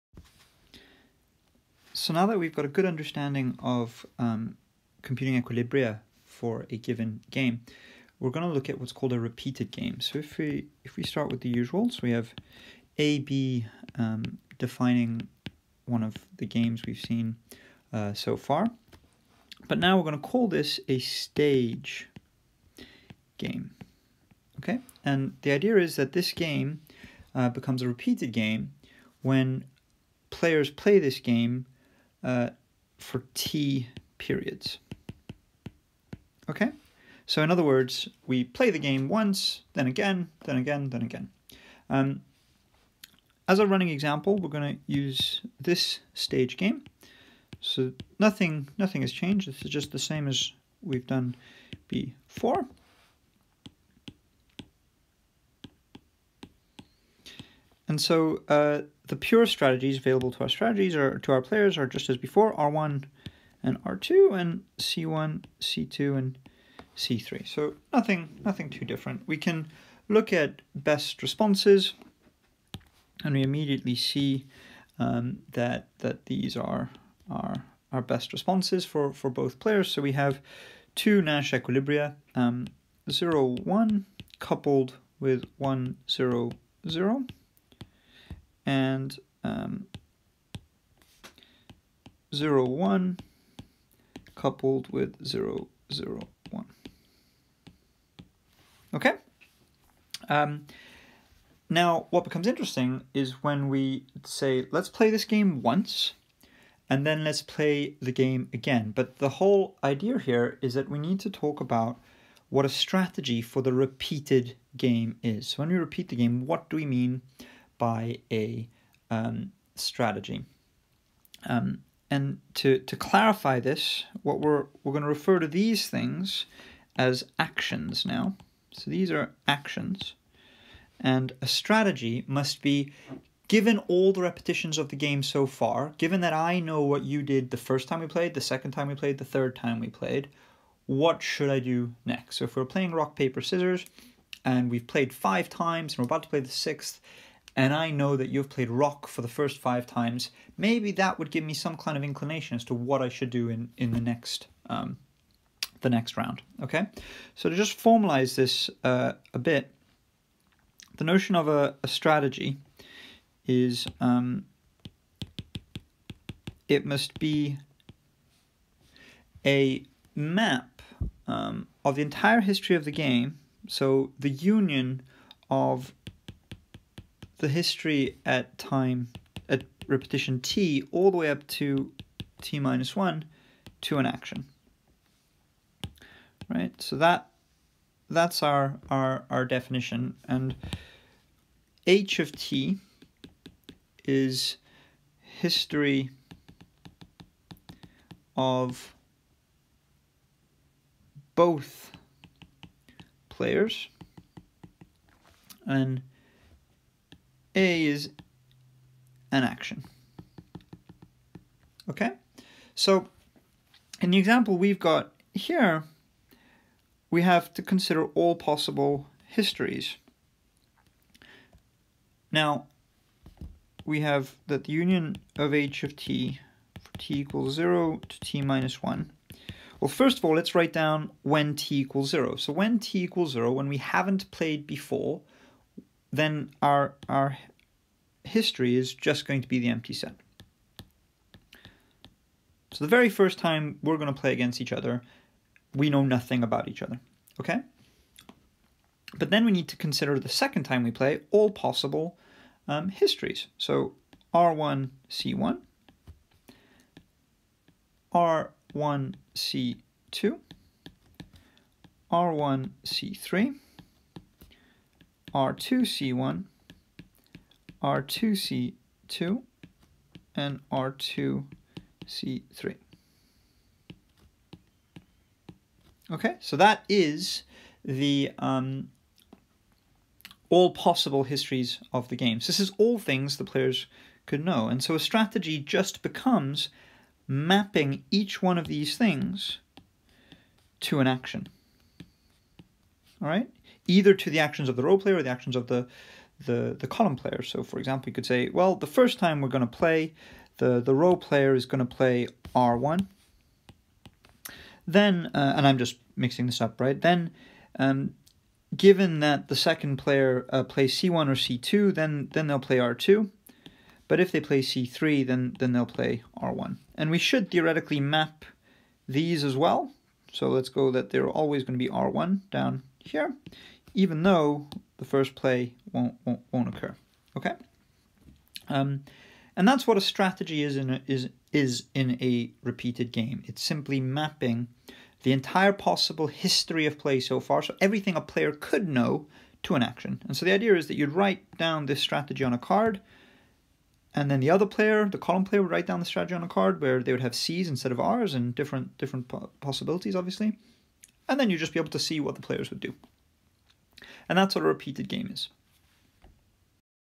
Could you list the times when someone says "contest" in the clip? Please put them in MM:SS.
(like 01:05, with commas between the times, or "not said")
not said.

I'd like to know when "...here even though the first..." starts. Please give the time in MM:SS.
05:22.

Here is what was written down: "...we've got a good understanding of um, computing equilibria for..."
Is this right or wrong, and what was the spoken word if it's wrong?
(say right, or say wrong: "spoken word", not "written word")
right.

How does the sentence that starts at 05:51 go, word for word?
And then you'd just be able to see what the players would do.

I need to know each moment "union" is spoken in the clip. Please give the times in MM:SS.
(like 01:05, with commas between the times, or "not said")
02:54, 03:44.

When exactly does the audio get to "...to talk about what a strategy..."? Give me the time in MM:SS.
01:51.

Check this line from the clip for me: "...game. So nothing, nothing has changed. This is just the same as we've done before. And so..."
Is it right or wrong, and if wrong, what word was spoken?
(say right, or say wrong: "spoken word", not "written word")
right.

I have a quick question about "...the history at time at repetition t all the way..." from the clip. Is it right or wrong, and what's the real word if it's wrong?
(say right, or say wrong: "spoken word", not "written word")
right.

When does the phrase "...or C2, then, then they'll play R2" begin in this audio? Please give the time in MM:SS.
05:11.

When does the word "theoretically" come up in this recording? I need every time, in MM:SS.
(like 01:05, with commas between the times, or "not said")
05:17.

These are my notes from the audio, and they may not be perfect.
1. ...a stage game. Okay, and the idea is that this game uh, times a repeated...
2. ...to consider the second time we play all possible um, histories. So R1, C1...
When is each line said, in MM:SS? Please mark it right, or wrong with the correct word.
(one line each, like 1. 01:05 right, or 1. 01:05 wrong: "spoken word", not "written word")
1. 00:20 wrong: "becomes", not "times"
2. 04:09 right.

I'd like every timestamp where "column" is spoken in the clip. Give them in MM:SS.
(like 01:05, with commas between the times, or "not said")
04:56, 05:45.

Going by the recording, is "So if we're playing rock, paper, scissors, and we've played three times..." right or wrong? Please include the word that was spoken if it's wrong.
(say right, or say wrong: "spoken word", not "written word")
wrong: "five", not "three".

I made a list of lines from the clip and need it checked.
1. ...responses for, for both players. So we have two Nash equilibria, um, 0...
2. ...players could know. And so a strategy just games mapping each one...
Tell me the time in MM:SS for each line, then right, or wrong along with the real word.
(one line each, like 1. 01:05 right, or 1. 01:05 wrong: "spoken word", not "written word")
1. 01:18 right
2. 04:43 wrong: "becomes", not "games".